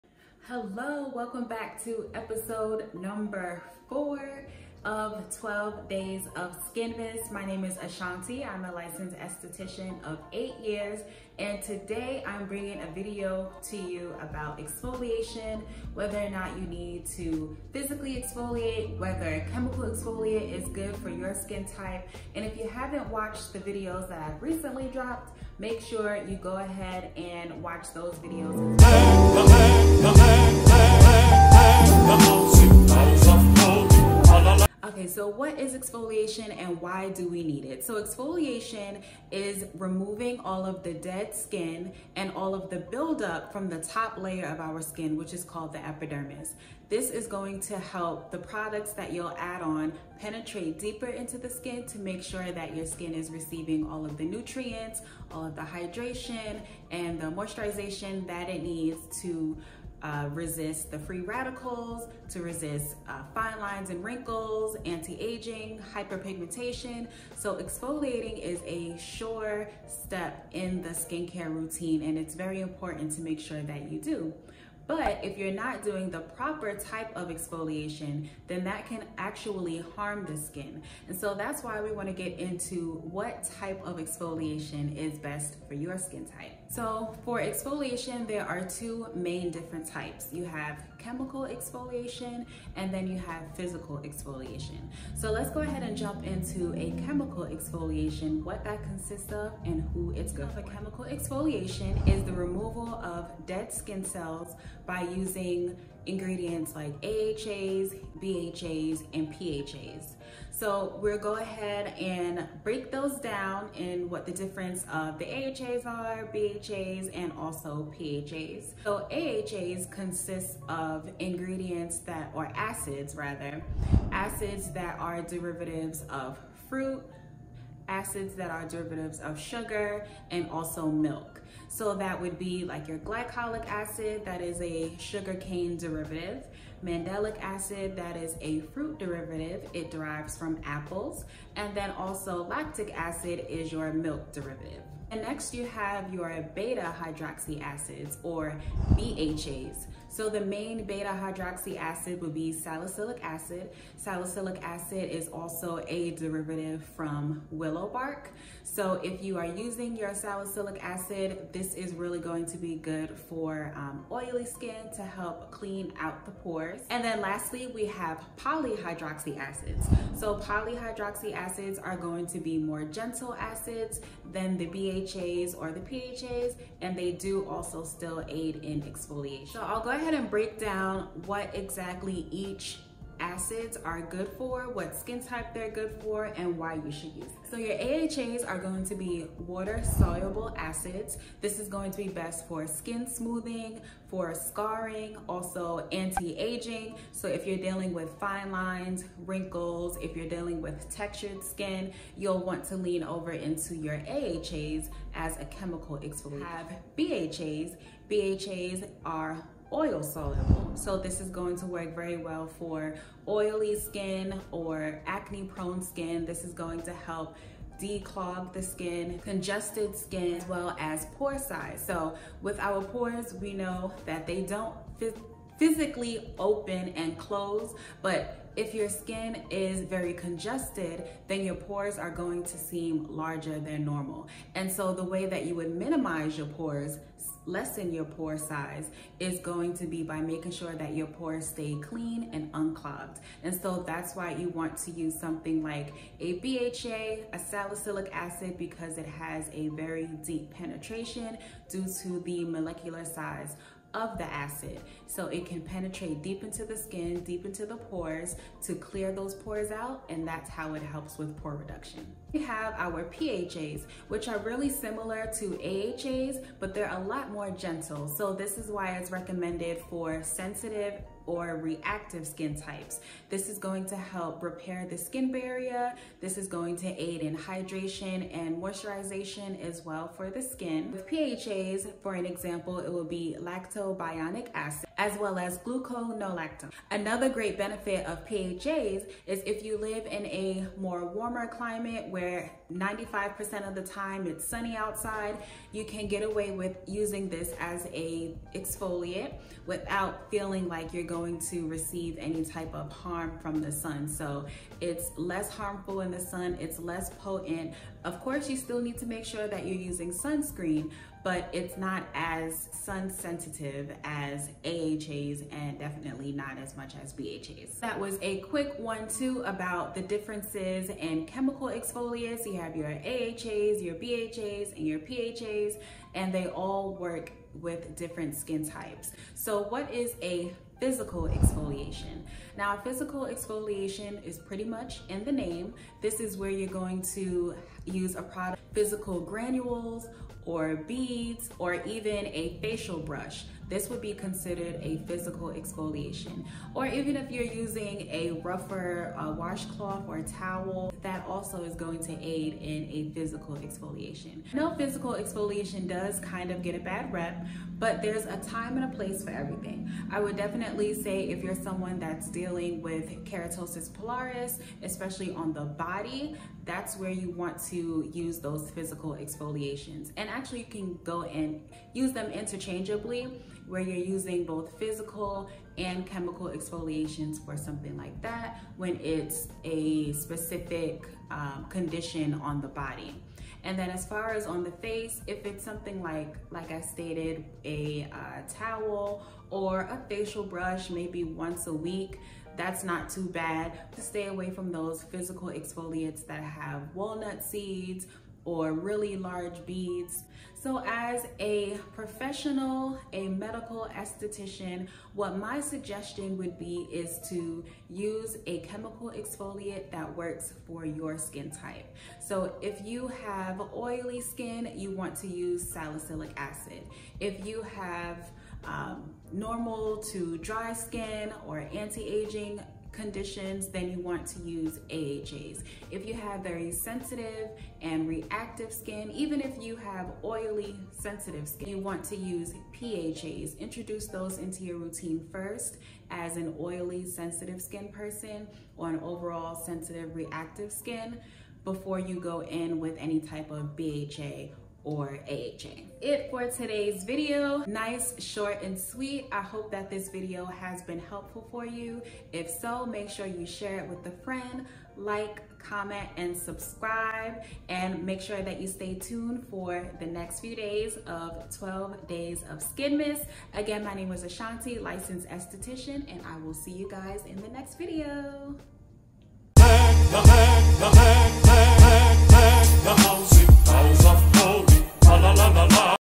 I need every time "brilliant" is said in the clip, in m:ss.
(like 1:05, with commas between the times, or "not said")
not said.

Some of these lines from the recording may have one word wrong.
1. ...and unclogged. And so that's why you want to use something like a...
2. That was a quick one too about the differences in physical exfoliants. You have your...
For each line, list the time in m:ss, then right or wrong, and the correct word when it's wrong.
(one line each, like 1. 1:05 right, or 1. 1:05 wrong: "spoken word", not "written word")
1. 4:02 right
2. 5:17 wrong: "chemical", not "physical".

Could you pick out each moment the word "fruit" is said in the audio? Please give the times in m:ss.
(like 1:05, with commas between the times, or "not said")
2:06, 2:18.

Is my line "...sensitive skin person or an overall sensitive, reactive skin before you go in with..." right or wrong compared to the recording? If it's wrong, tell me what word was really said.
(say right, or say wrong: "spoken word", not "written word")
right.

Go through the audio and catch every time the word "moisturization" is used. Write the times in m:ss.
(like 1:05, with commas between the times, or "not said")
0:57, 4:38.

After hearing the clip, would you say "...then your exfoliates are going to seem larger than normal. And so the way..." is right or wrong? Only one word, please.
wrong.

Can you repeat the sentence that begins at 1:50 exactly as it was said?
So we'll go ahead and break those down in what the difference of the AHAs are, BHAs, and also PHAs.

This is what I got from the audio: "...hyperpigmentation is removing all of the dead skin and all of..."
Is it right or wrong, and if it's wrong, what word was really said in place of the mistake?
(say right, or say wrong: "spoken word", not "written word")
wrong: "exfoliation", not "hyperpigmentation".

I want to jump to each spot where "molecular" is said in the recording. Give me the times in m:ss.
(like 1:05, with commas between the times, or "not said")
4:12.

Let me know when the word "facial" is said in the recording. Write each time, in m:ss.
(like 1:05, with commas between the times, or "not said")
5:42, 6:30.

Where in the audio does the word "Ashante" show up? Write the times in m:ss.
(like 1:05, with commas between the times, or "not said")
0:07, 7:44.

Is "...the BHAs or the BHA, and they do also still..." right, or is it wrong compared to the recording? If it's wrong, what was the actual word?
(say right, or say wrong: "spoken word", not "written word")
wrong: "PHAs", not "BHA".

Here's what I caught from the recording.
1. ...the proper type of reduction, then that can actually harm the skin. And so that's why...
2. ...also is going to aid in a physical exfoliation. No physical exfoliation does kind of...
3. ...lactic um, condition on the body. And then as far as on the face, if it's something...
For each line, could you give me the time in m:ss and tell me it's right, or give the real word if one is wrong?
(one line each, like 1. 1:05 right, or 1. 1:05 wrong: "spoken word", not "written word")
1. 1:16 wrong: "exfoliation", not "reduction"
2. 5:51 right
3. 6:20 wrong: "specific", not "lactic".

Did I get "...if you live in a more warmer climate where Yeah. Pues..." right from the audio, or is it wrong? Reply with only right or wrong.
right.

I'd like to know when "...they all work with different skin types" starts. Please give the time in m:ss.
5:26.